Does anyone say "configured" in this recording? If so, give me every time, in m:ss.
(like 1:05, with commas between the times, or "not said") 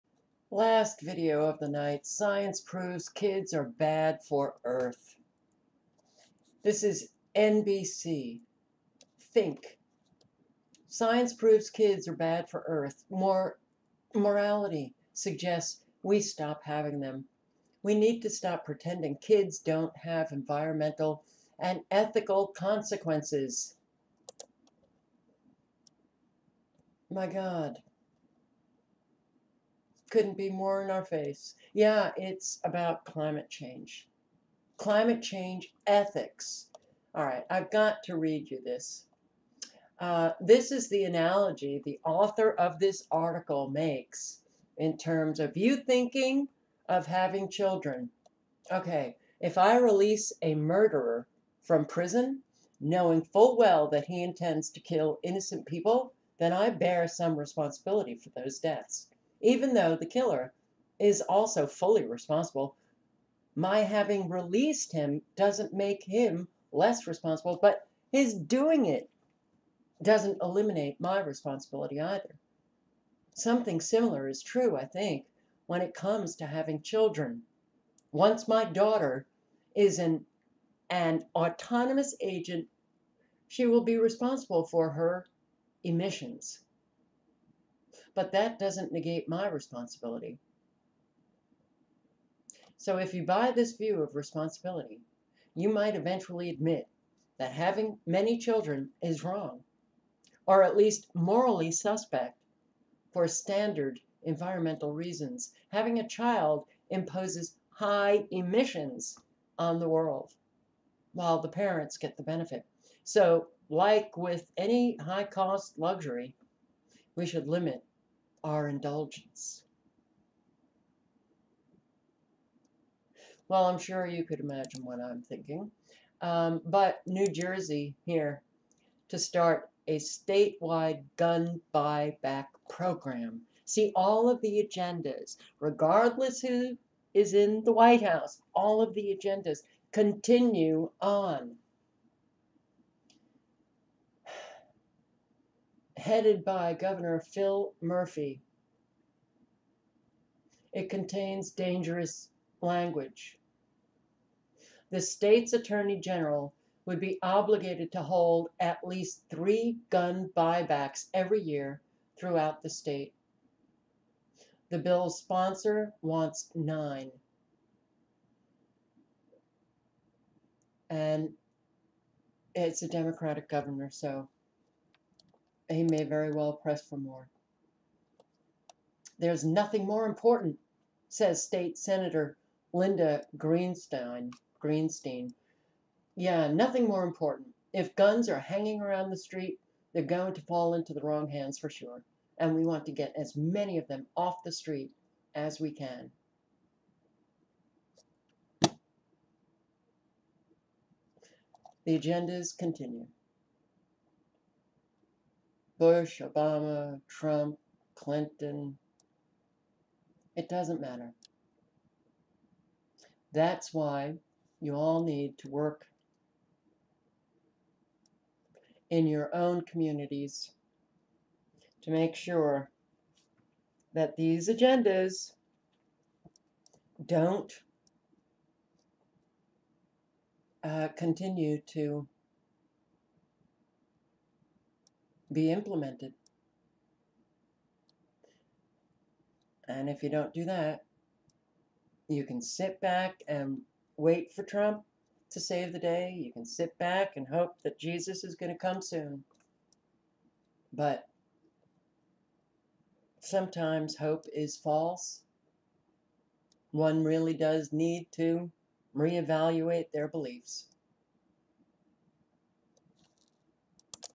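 not said.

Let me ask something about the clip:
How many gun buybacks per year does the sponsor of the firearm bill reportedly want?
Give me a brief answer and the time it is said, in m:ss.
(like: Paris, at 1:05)
9, at 2:46.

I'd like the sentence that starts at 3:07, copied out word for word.
If guns are hanging around the street, they're going to fall into the wrong hands for sure.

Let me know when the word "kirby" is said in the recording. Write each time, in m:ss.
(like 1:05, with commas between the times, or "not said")
not said.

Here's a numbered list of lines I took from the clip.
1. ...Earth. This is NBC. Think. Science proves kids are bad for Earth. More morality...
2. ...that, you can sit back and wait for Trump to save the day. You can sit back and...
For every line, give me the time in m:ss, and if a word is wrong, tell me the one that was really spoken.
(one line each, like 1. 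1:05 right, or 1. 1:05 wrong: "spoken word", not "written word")
1. 0:04 right
2. 4:00 right.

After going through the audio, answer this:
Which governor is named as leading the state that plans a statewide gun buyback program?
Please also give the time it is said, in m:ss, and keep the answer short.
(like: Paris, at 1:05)
Phil Murphy, at 2:27.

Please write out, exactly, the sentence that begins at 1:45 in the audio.
Having a child imposes high emissions on the world while the parents get the benefit.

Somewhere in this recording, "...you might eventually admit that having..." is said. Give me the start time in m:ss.
1:35.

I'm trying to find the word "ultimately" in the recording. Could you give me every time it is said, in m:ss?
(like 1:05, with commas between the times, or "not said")
not said.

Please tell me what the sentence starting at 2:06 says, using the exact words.
Um, but New Jersey here to start a statewide gun buyback program.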